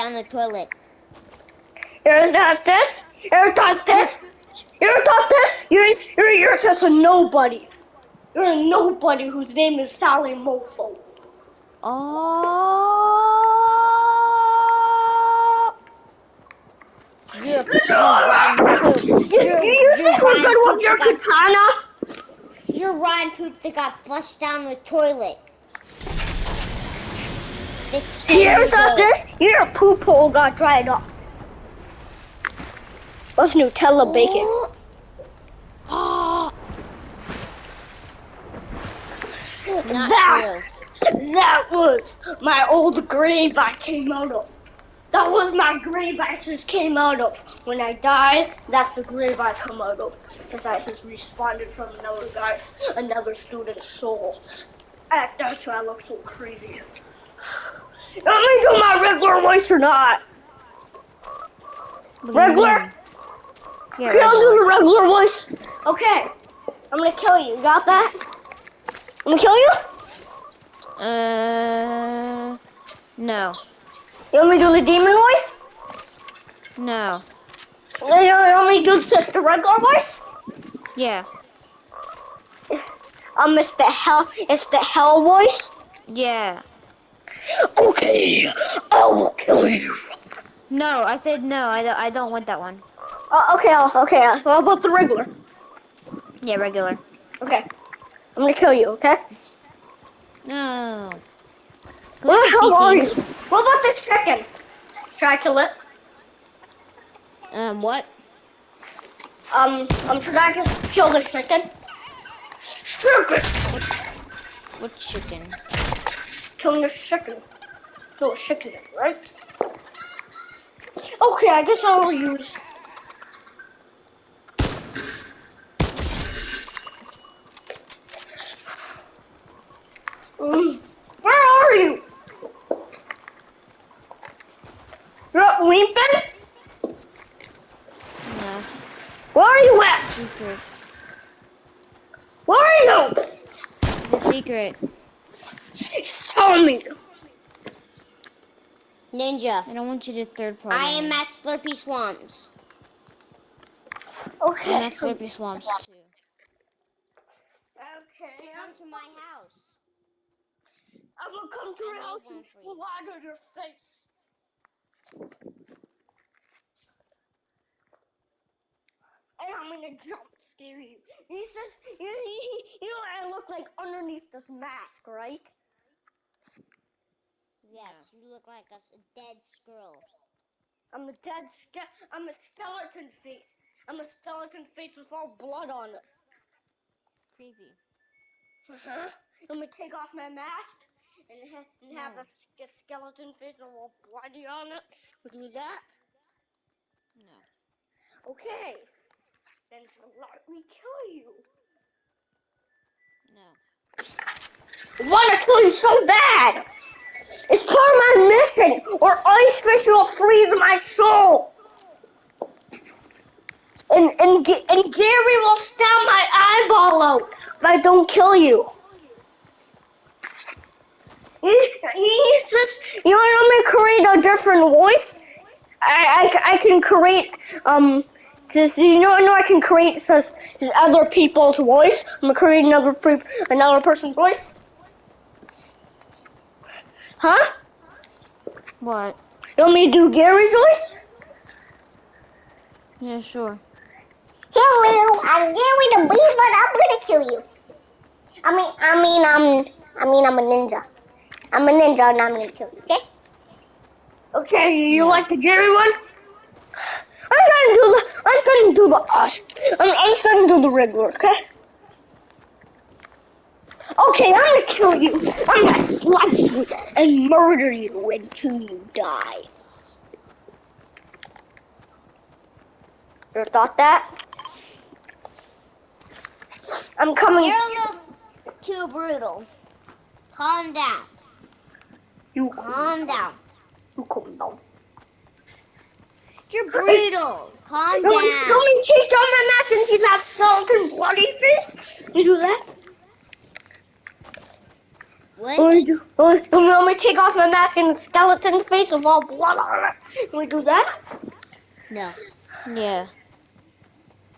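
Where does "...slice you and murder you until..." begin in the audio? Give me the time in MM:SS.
04:25.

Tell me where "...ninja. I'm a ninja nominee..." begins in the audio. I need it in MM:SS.
04:10.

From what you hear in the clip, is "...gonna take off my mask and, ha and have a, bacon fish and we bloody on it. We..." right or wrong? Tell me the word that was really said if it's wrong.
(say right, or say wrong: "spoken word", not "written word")
wrong: "skeleton", not "bacon".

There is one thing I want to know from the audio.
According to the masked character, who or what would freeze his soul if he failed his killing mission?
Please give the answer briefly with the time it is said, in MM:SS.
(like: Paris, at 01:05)
Ice Fish, at 03:29.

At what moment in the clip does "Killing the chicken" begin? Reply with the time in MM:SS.
01:56.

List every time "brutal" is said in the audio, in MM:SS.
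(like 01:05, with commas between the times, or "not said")
04:38, 04:46.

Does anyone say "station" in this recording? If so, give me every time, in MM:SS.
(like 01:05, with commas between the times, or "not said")
not said.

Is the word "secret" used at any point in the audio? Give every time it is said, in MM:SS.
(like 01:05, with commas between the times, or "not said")
02:19, 02:24.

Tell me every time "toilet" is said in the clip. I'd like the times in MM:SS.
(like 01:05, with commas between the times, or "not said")
00:00, 00:24.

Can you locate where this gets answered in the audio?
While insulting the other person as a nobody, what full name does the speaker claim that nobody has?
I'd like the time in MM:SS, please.
00:09.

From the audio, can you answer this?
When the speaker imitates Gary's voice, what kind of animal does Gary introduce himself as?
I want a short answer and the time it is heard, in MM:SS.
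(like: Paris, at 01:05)
Beaver, at 04:06.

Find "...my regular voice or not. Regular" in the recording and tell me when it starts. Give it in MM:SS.
00:58.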